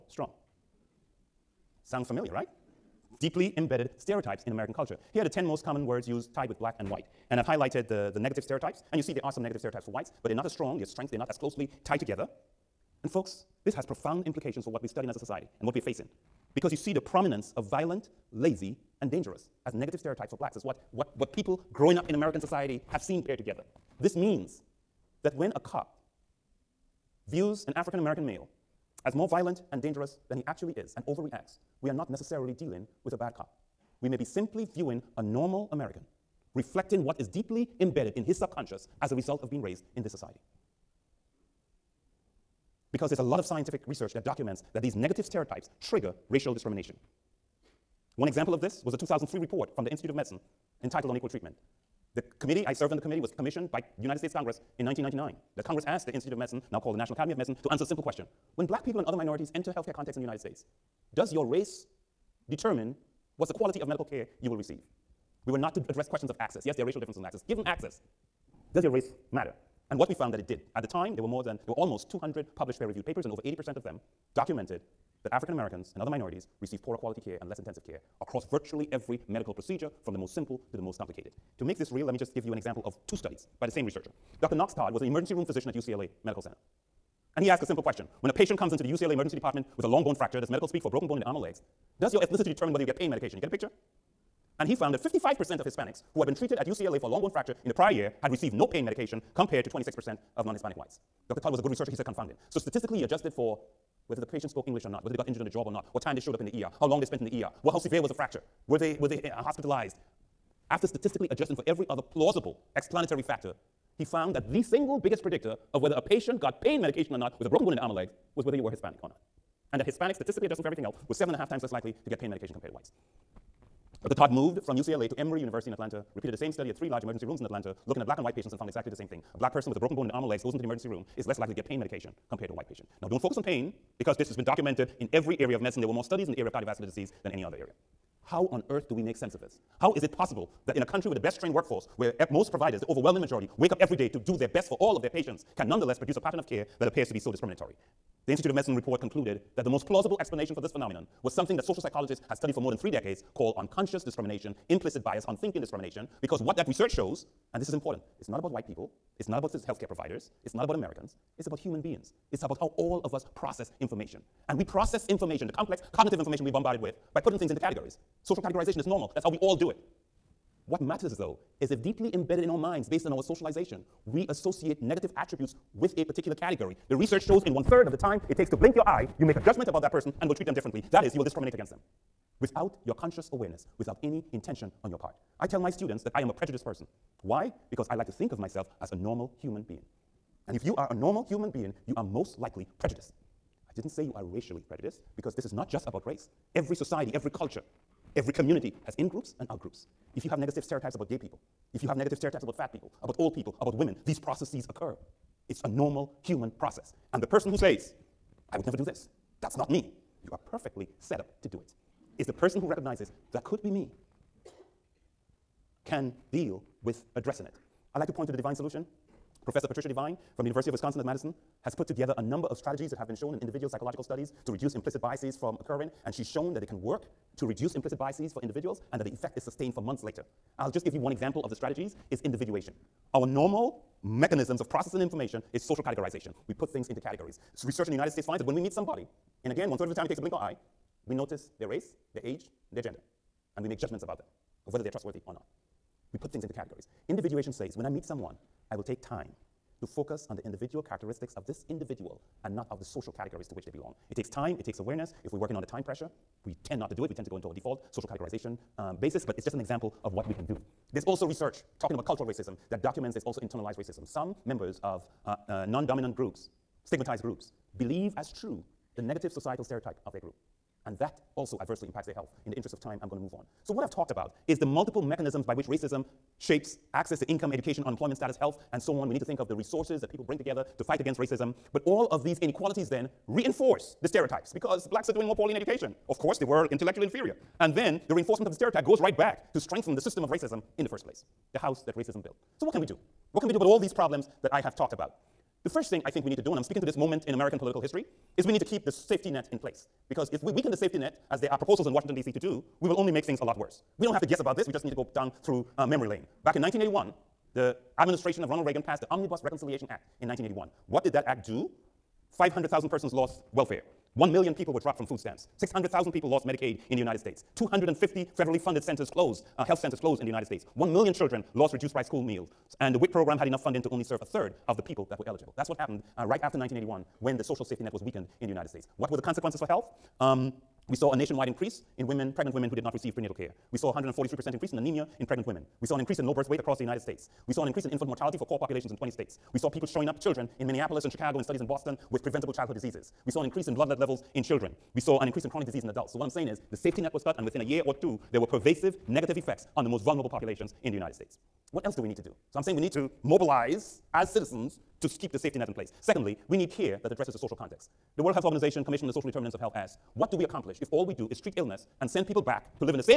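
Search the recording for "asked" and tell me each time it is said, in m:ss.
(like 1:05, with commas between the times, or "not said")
0:55, 1:27.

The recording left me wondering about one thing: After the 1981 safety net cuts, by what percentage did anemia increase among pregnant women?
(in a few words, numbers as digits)
143%.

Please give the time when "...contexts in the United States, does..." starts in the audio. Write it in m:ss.
0:59.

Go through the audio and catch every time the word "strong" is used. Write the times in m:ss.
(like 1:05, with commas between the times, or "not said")
0:00, 0:10.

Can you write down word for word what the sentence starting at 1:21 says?
To make this real, let me just give you an example of two studies by the same researcher.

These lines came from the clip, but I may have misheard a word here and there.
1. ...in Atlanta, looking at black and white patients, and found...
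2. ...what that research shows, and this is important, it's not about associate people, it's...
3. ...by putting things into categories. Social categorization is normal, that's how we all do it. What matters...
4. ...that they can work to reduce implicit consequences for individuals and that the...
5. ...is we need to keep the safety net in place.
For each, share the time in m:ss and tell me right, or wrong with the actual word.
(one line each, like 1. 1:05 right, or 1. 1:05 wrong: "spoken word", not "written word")
1. 2:07 right
2. 2:36 wrong: "white", not "associate"
3. 2:47 right
4. 3:46 wrong: "biases", not "consequences"
5. 4:58 right.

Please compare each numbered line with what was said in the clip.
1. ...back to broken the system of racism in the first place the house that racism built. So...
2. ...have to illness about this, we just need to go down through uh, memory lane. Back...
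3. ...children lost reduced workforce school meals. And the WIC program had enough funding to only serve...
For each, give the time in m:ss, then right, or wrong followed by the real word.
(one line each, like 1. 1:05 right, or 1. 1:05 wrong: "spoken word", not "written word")
1. 4:49 wrong: "strengthen", not "broken"
2. 5:04 wrong: "guess", not "illness"
3. 5:21 wrong: "price", not "workforce".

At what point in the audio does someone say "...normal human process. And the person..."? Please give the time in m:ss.
3:25.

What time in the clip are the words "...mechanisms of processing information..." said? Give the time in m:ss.
3:54.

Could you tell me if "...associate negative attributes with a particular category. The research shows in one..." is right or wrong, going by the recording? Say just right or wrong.
right.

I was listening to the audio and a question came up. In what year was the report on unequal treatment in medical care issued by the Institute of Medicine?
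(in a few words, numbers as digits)
2003.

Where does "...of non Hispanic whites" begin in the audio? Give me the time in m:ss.
1:40.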